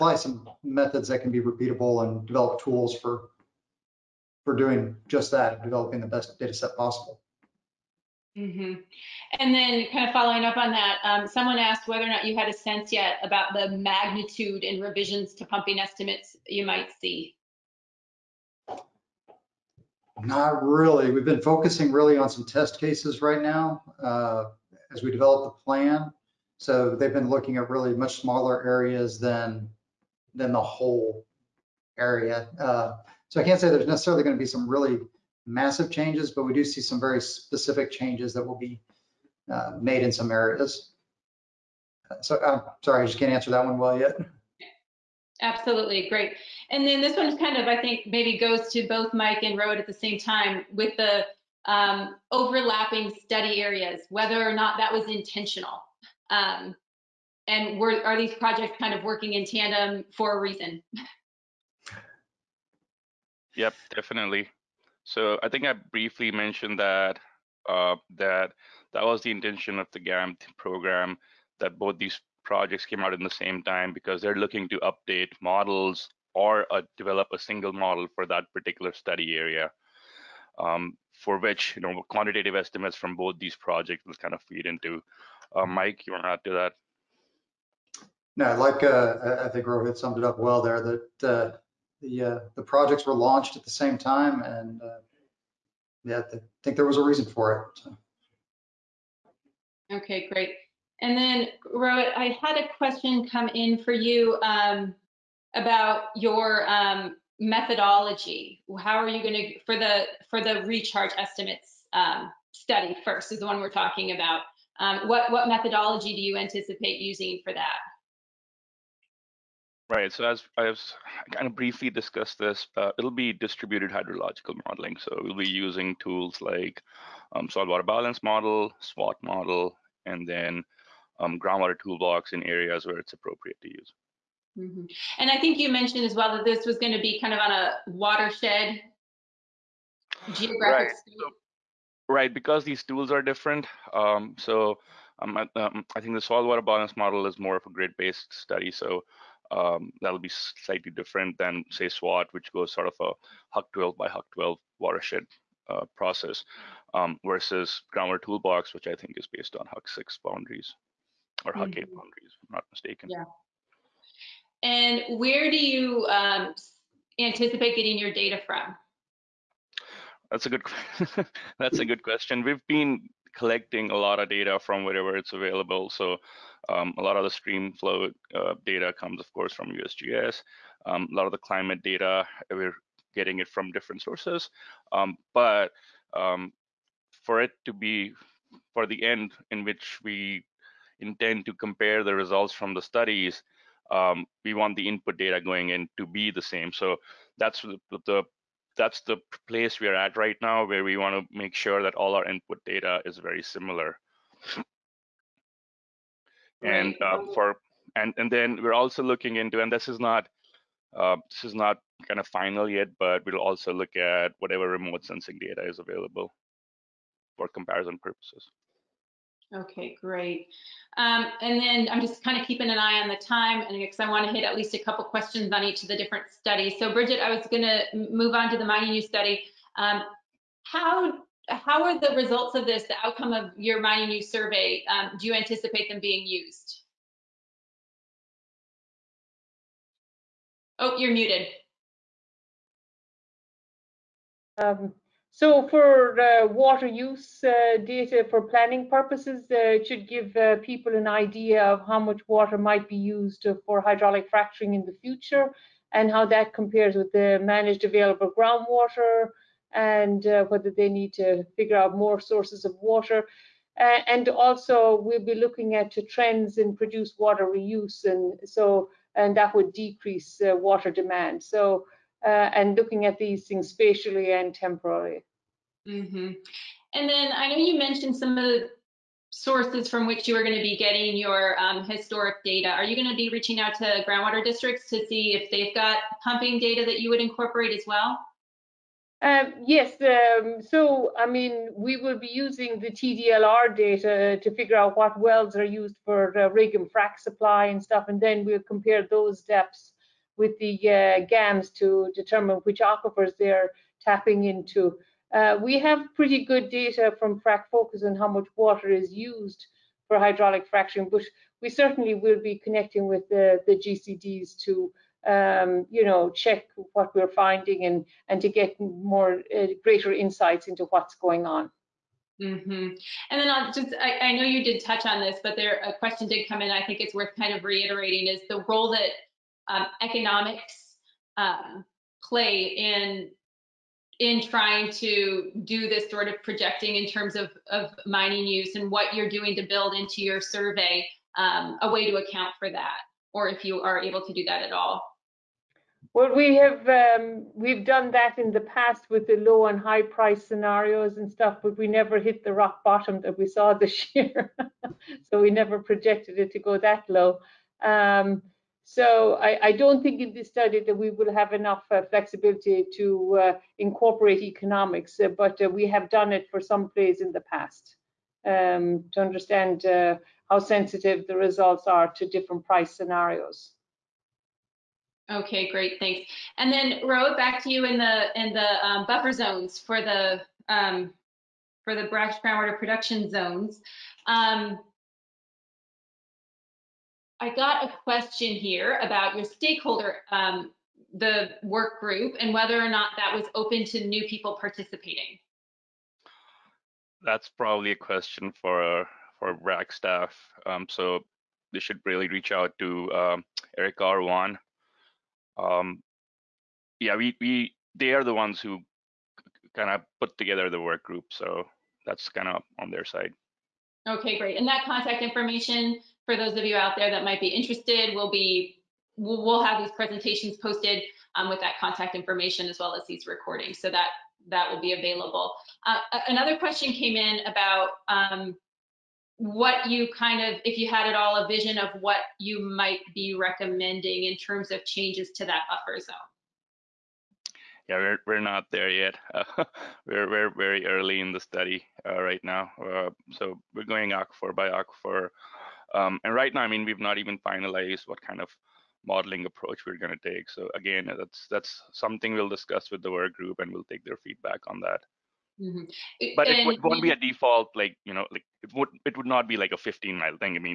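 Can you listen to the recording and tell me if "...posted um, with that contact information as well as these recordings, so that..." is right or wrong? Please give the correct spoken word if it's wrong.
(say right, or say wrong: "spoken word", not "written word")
right.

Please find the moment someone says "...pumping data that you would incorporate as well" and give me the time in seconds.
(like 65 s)
286 s.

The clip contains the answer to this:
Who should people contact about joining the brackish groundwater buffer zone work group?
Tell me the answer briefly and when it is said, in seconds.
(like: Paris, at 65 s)
Eric, at 403 s.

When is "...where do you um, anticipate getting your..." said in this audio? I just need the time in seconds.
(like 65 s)
165 s.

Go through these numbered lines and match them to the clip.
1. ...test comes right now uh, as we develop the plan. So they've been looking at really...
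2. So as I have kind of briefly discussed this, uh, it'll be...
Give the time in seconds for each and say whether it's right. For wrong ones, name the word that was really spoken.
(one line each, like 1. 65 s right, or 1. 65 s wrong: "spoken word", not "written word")
1. 22 s wrong: "cases", not "comes"
2. 120 s right.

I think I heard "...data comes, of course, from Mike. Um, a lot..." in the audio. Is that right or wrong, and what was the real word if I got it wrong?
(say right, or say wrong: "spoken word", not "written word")
wrong: "USGS", not "Mike".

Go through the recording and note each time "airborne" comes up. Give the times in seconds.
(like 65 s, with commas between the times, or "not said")
not said.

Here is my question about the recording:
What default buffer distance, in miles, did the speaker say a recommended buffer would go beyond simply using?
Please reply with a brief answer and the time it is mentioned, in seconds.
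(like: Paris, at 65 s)
15, at 459 s.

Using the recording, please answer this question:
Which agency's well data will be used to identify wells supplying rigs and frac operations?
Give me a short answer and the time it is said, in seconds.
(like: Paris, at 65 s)
TDLR, at 292 s.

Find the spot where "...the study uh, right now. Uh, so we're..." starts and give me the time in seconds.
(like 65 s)
441 s.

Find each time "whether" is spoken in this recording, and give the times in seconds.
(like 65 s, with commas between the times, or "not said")
11 s, 54 s, 260 s, 392 s.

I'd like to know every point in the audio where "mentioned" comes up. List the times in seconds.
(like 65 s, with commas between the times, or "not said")
66 s, 135 s, 277 s.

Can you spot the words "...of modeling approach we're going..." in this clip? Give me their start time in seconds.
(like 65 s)
448 s.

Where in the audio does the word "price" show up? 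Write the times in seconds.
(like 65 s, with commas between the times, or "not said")
350 s, 372 s.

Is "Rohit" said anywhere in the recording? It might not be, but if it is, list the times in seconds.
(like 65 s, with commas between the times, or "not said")
49 s, 89 s, 101 s.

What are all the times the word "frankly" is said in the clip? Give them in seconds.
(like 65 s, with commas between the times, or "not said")
not said.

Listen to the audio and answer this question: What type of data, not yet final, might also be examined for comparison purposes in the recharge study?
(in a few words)
Remote sensing data.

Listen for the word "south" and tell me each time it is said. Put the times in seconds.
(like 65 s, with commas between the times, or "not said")
not said.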